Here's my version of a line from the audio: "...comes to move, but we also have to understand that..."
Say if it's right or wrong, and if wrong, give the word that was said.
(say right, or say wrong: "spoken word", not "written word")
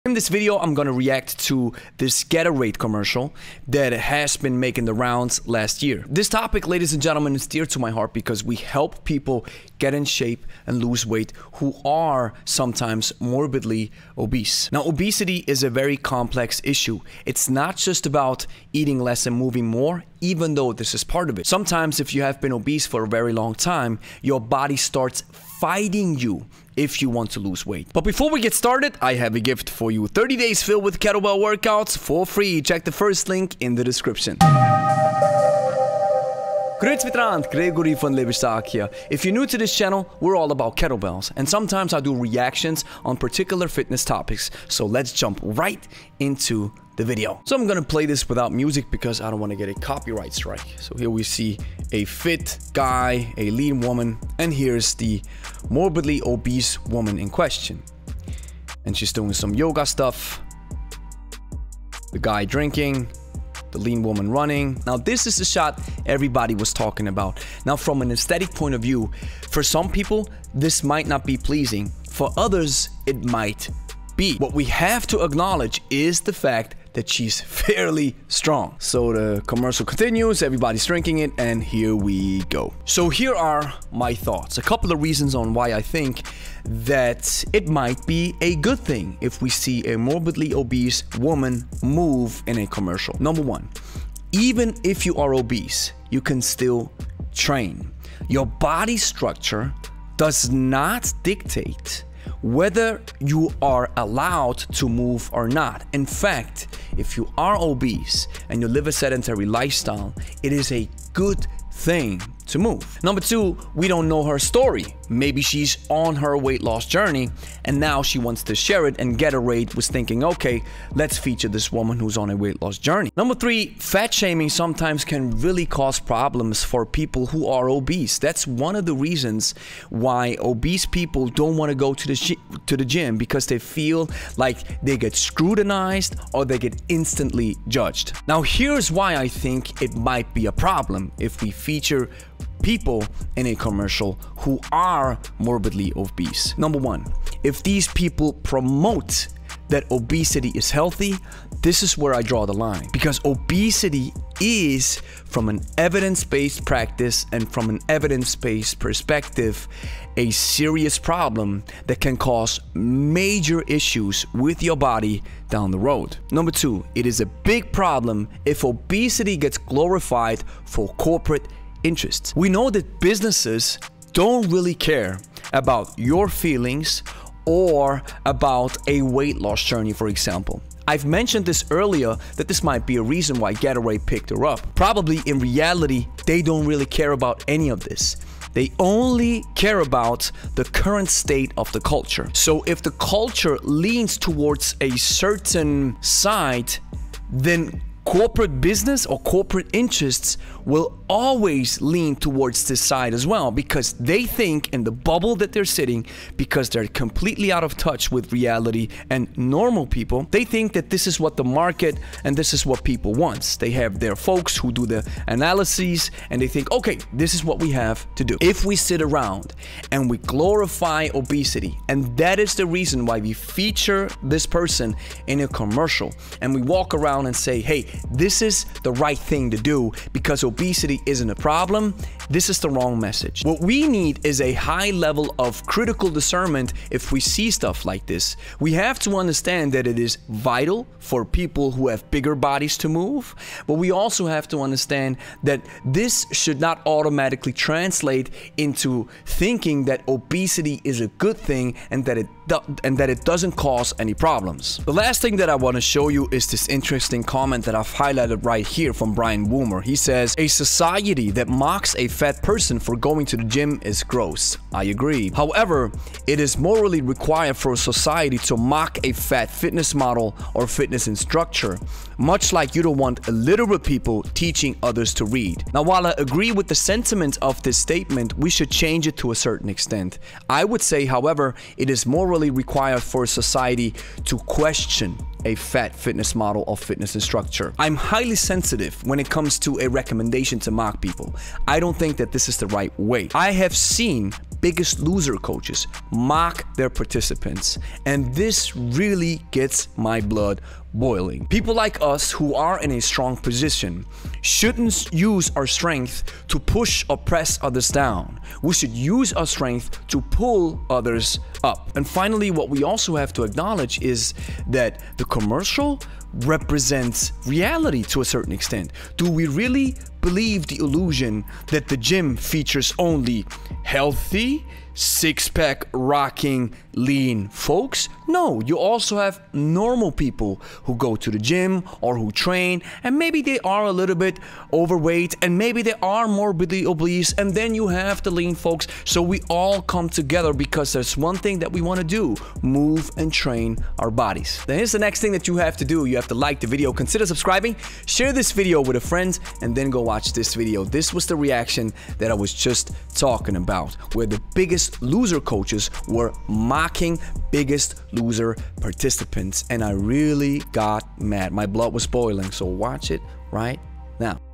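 wrong: "bodies", not "comes".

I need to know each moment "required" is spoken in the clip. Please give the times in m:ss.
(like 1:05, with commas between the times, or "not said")
4:27, 4:42.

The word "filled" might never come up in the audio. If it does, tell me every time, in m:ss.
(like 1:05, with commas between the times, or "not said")
0:30.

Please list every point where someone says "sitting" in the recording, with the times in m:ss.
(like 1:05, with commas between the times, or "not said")
3:25.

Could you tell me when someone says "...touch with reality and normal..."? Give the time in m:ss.
3:27.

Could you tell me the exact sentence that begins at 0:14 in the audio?
Now, obesity is a very complex issue.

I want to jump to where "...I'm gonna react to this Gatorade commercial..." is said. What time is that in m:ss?
0:00.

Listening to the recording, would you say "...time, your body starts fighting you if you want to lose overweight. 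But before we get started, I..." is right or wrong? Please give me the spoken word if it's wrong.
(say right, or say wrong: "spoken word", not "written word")
wrong: "weight", not "overweight".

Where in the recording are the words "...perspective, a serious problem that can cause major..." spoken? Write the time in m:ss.
2:38.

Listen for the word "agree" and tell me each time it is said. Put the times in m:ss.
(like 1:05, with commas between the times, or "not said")
4:24, 4:36.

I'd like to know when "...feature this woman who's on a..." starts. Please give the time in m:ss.
2:01.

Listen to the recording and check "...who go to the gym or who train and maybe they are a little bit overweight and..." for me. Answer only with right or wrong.
right.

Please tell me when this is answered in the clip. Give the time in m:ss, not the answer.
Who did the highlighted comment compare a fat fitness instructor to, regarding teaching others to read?
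4:33.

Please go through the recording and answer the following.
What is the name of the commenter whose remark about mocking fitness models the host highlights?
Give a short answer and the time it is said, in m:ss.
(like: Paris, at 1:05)
Brian Woomer, at 4:19.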